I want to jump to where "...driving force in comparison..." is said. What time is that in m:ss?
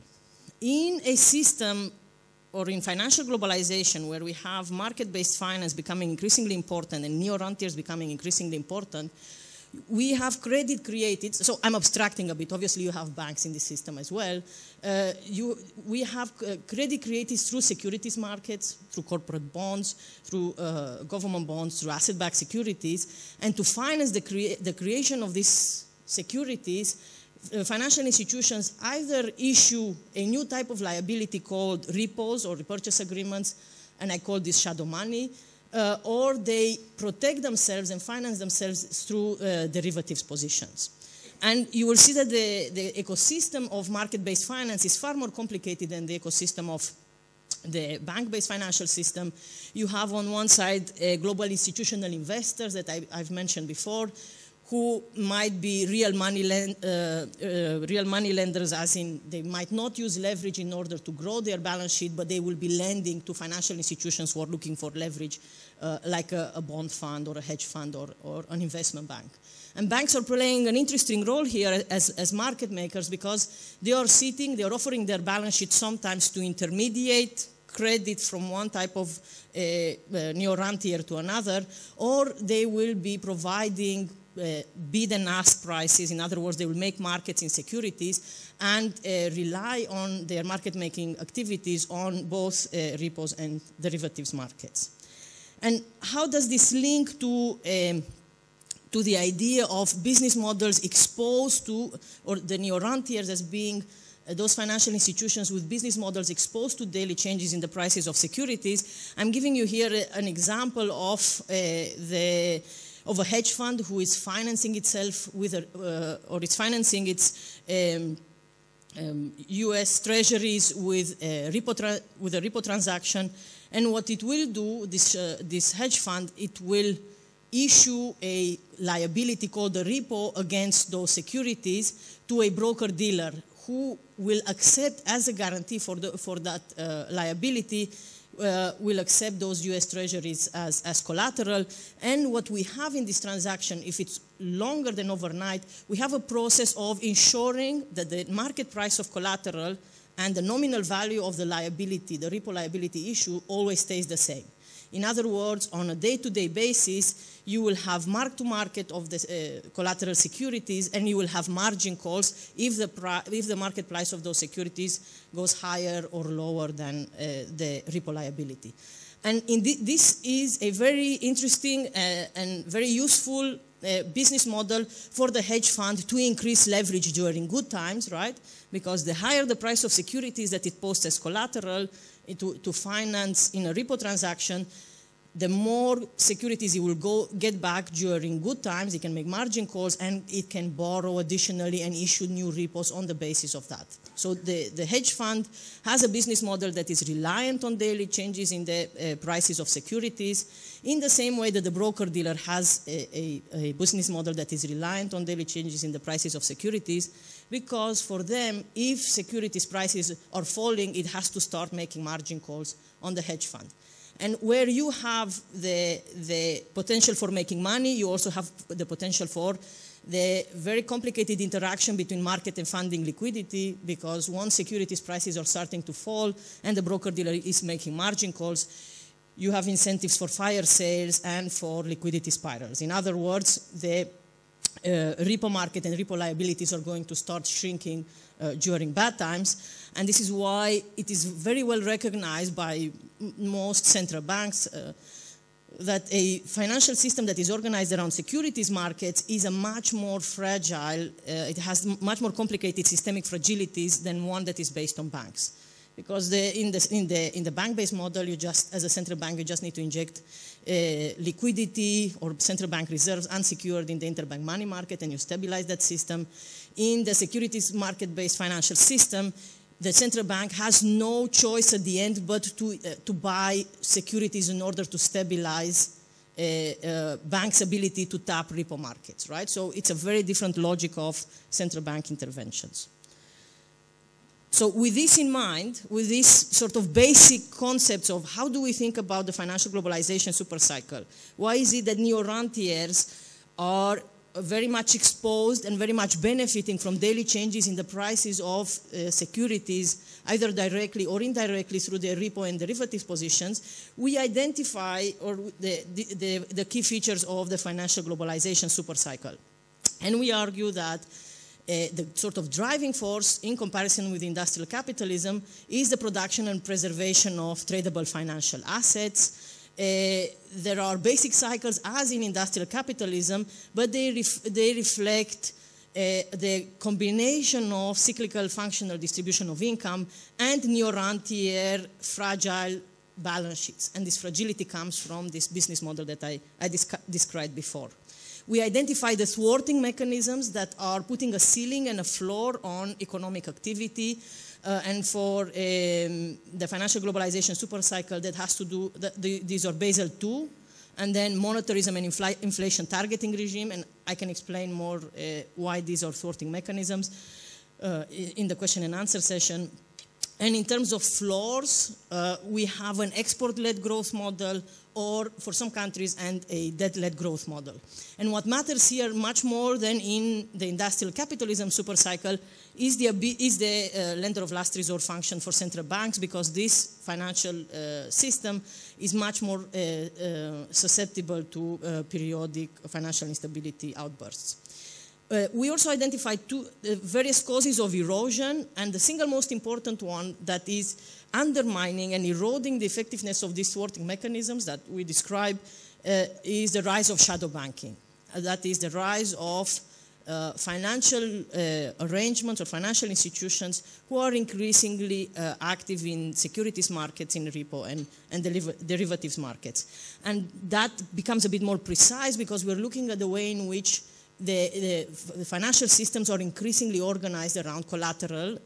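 5:12.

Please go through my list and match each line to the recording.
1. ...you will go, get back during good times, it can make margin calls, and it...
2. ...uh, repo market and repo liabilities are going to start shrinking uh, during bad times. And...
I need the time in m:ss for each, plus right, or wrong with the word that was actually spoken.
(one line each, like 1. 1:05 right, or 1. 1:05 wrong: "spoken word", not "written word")
1. 3:06 right
2. 3:54 right.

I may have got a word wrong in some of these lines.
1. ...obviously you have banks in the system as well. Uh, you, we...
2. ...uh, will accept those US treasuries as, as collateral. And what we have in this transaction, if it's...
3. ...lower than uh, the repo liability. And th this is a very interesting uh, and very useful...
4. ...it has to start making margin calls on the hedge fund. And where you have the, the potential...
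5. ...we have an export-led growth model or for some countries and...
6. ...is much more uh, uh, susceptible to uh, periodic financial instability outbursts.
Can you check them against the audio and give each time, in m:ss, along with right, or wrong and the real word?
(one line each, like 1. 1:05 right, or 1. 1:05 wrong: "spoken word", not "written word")
1. 0:12 right
2. 2:18 right
3. 2:46 right
4. 3:30 right
5. 6:02 right
6. 6:18 right.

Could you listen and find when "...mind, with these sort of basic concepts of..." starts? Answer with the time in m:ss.
4:45.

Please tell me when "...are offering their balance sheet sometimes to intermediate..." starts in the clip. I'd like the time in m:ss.
1:14.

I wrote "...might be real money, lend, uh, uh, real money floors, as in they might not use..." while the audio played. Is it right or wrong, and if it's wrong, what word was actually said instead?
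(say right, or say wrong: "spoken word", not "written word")
wrong: "lenders", not "floors".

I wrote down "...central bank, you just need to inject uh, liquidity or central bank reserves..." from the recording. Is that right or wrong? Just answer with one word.
right.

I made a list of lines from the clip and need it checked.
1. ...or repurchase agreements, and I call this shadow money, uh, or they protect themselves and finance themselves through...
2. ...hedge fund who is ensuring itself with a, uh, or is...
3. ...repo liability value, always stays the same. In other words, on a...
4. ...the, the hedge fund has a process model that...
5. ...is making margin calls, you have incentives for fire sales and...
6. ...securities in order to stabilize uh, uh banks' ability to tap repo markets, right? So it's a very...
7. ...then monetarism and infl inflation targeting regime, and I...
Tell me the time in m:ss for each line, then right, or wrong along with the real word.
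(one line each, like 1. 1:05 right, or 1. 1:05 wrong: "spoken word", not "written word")
1. 0:32 right
2. 1:53 wrong: "financing", not "ensuring"
3. 2:32 wrong: "issue", not "value"
4. 3:14 wrong: "business", not "process"
5. 3:47 right
6. 4:33 right
7. 5:51 right.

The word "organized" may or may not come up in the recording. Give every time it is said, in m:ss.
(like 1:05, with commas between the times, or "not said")
4:07, 6:57.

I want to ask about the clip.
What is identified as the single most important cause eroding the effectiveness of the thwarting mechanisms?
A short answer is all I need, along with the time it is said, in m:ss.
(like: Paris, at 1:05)
the rise of shadow banking, at 6:37.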